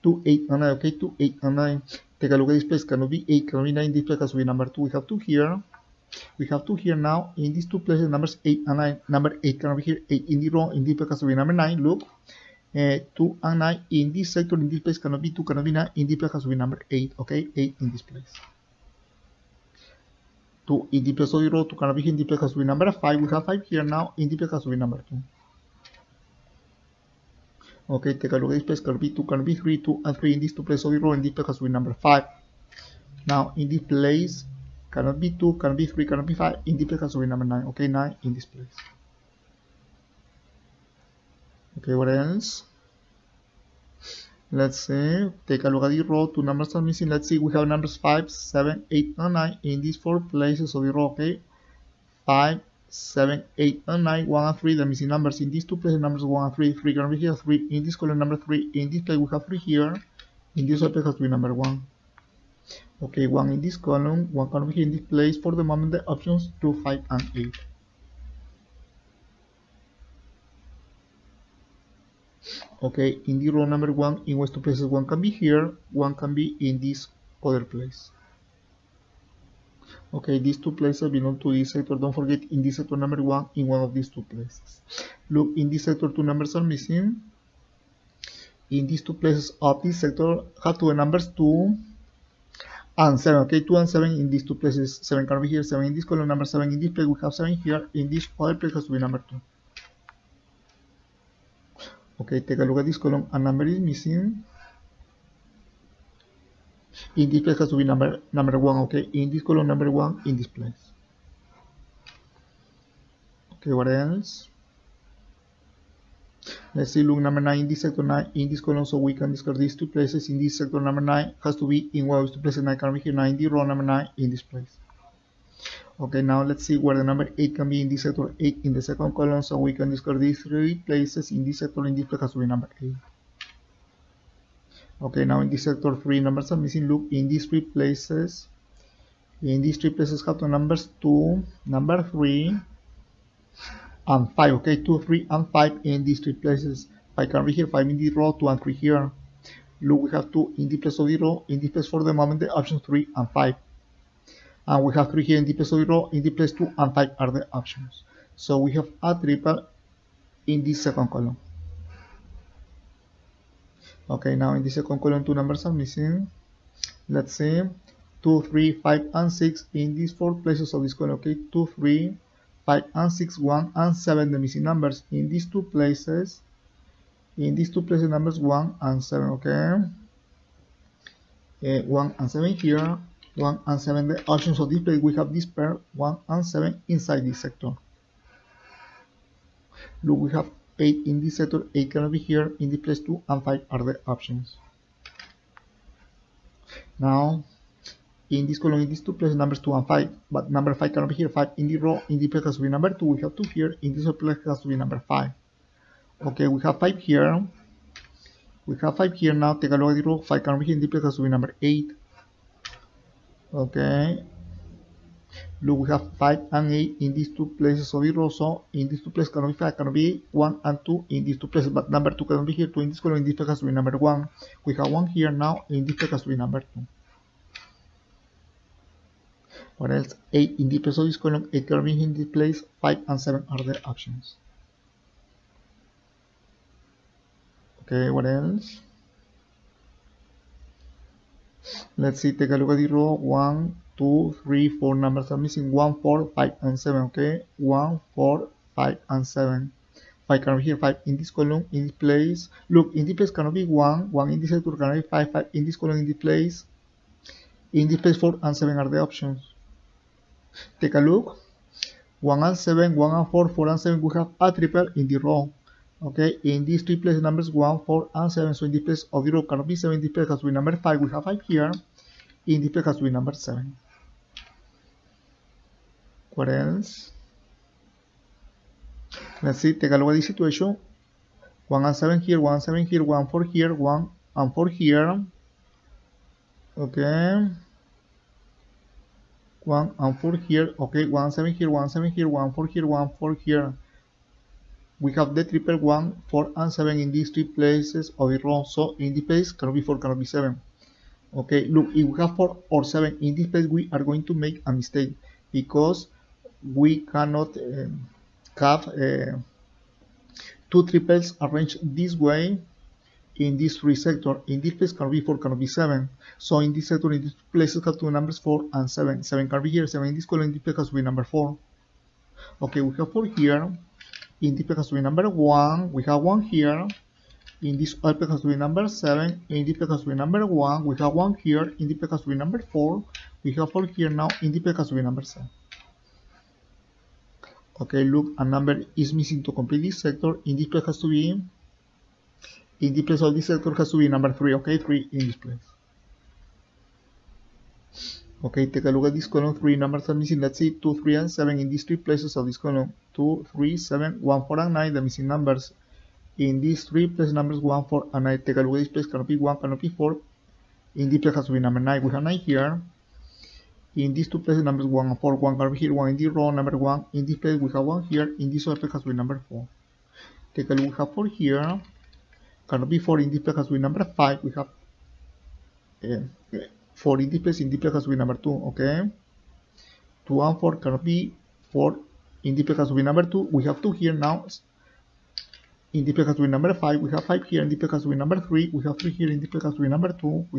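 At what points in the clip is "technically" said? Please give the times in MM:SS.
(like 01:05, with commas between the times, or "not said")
06:10.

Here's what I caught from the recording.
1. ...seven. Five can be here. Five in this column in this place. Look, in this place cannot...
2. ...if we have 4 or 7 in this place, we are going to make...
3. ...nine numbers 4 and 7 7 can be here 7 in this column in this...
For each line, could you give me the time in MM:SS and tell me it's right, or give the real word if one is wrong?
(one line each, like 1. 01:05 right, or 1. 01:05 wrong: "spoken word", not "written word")
1. 04:09 right
2. 05:01 right
3. 05:17 wrong: "two", not "nine".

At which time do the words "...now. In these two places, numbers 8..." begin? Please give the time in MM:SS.
00:06.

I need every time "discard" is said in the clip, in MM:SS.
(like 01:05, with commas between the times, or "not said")
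01:59, 02:09.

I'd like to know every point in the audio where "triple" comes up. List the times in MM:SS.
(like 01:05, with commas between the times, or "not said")
02:39, 04:24, 04:55, 05:10.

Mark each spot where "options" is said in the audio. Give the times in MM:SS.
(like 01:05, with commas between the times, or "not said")
01:06, 02:32, 02:37, 03:04, 03:14, 03:53, 04:19.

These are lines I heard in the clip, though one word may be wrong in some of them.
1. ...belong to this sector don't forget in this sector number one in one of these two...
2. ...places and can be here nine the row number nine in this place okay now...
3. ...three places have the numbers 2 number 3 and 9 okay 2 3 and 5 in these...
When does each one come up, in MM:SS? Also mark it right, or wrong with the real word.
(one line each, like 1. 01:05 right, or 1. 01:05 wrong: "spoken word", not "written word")
1. 01:21 right
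2. 02:02 right
3. 02:19 wrong: "5", not "9".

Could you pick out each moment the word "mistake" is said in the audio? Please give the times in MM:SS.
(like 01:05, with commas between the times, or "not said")
05:04.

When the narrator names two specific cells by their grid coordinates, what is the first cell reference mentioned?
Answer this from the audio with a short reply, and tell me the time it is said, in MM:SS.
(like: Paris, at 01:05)
B2, at 00:28.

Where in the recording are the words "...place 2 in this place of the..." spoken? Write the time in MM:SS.
00:18.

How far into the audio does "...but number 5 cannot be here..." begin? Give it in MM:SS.
03:20.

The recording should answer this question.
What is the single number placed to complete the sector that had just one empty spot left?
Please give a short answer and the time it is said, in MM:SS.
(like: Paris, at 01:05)
3, at 05:44.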